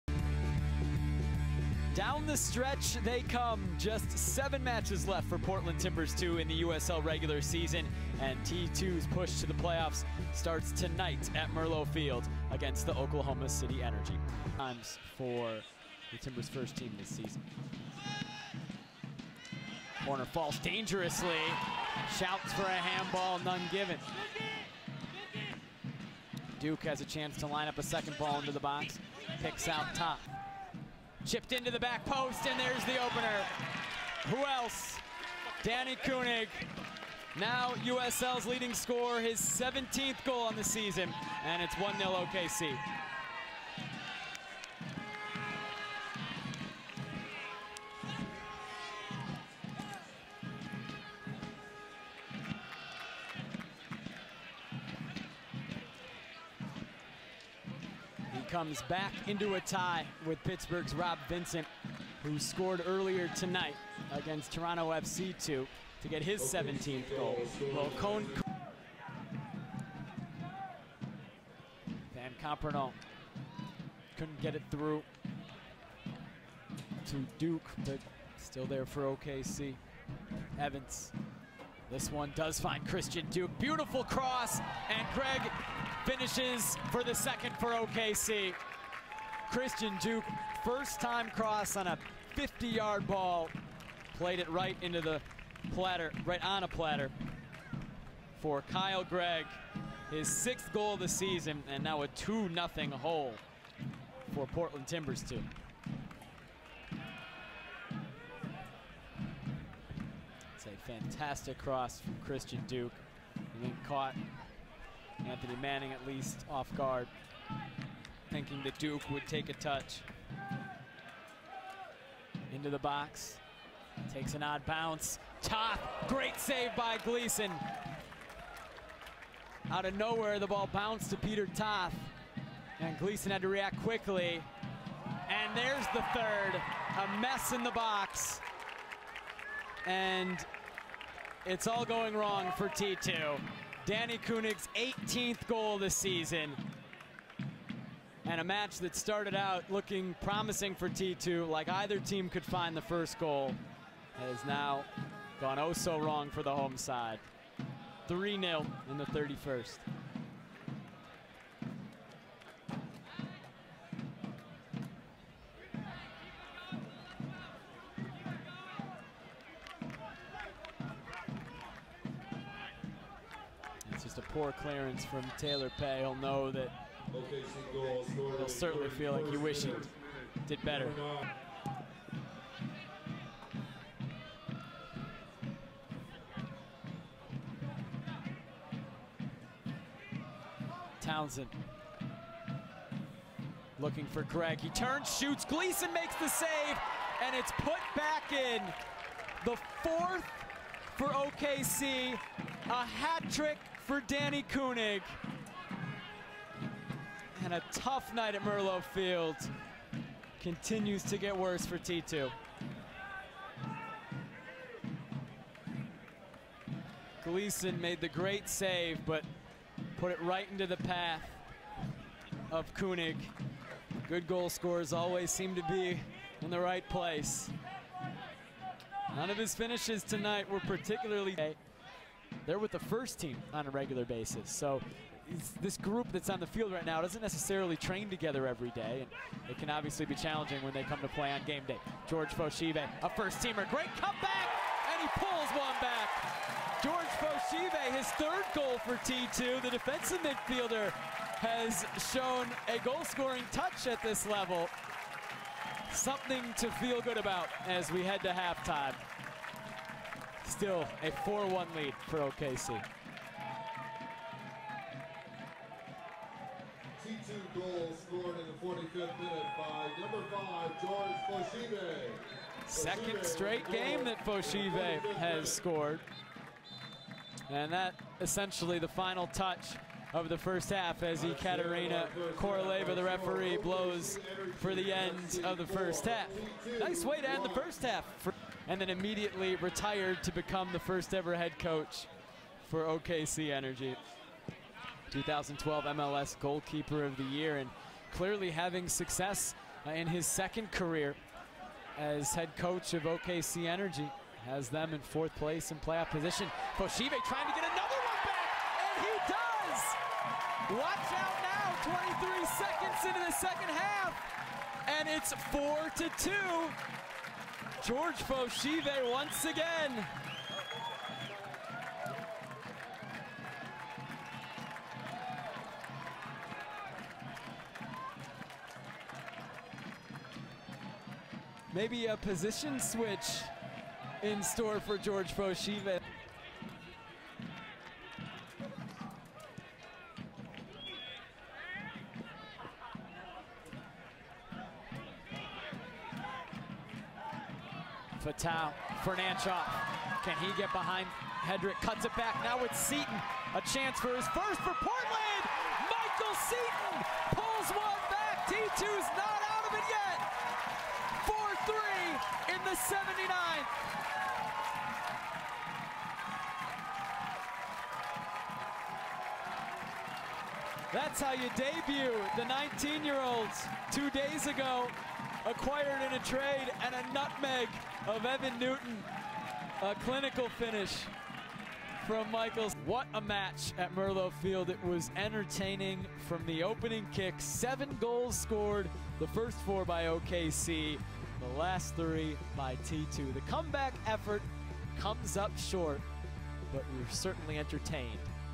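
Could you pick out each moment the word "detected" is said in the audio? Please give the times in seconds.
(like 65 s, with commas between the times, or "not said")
not said.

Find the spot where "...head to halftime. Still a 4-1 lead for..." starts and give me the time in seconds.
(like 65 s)
258 s.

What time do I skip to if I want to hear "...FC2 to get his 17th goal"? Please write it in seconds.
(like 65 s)
64 s.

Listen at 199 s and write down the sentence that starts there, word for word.
The fourth for OKC, a hat trick for Danni König.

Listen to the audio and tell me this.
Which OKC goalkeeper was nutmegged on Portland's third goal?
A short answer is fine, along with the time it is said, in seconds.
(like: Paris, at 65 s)
Evan Newton, at 378 s.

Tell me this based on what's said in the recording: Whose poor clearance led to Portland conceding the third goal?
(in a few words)
Taylor Peay.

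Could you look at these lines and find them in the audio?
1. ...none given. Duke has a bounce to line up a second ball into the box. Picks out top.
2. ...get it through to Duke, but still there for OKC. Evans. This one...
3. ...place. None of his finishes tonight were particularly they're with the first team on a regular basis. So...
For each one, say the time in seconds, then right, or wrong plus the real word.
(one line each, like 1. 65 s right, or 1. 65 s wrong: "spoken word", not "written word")
1. 23 s wrong: "chance", not "bounce"
2. 74 s right
3. 226 s right.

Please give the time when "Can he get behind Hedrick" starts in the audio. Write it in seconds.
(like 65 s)
350 s.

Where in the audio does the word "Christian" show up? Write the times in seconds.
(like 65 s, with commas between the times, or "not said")
82 s, 89 s, 112 s.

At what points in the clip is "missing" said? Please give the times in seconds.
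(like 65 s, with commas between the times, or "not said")
not said.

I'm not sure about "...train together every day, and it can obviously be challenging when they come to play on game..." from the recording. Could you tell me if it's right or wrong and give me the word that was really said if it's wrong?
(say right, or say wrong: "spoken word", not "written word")
right.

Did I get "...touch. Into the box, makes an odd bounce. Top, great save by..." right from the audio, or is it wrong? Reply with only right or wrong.
wrong.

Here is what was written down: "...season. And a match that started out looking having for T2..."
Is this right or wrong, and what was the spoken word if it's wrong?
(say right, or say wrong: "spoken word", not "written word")
wrong: "promising", not "having".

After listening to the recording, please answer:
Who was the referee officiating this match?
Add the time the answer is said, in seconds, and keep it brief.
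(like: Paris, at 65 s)
Ekaterina Koroleva, at 281 s.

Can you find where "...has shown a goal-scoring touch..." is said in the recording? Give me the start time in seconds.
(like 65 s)
250 s.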